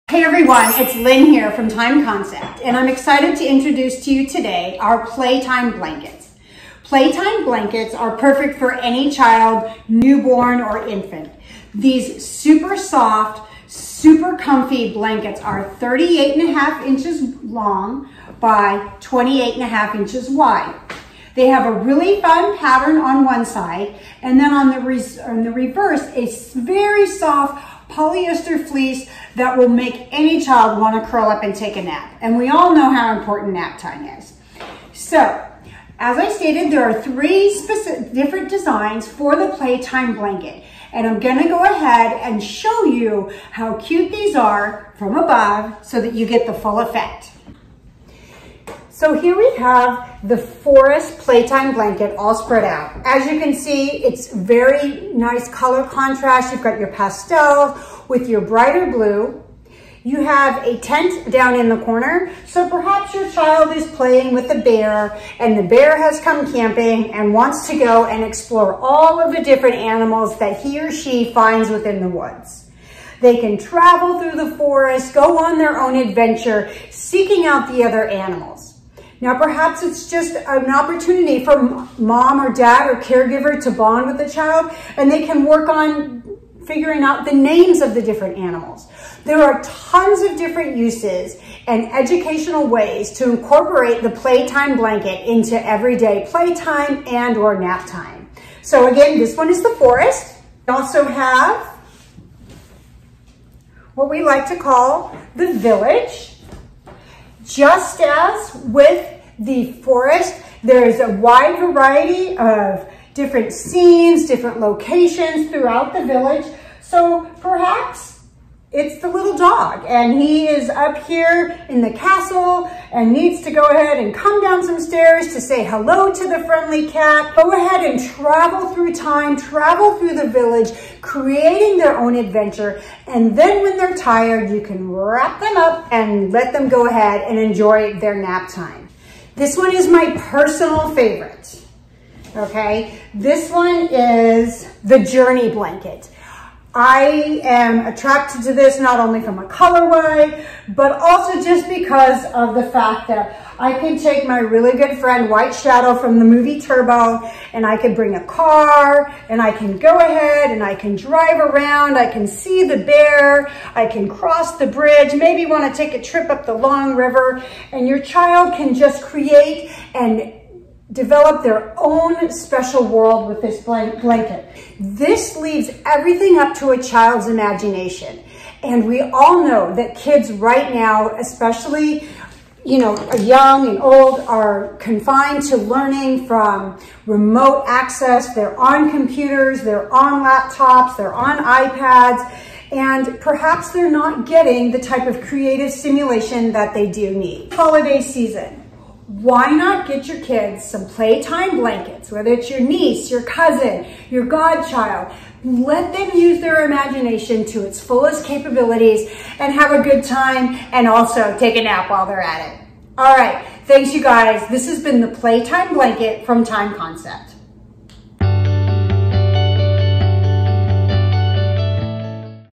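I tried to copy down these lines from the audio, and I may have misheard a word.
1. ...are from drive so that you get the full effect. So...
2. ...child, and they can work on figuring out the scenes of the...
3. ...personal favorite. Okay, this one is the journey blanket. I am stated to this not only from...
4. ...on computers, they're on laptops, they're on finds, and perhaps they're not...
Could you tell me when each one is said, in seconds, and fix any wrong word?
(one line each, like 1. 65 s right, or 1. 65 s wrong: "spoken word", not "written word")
1. 44 s wrong: "above", not "drive"
2. 84 s wrong: "names", not "scenes"
3. 140 s wrong: "attracted", not "stated"
4. 188 s wrong: "iPads", not "finds".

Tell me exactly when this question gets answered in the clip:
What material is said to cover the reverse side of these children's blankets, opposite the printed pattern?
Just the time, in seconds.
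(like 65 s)
27 s.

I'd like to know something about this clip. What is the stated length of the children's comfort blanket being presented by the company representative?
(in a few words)
38.5 inches.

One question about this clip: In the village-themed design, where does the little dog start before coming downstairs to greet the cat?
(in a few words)
the castle.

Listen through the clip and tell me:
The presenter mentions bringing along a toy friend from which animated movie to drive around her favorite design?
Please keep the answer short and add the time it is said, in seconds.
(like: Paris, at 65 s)
Turbo, at 156 s.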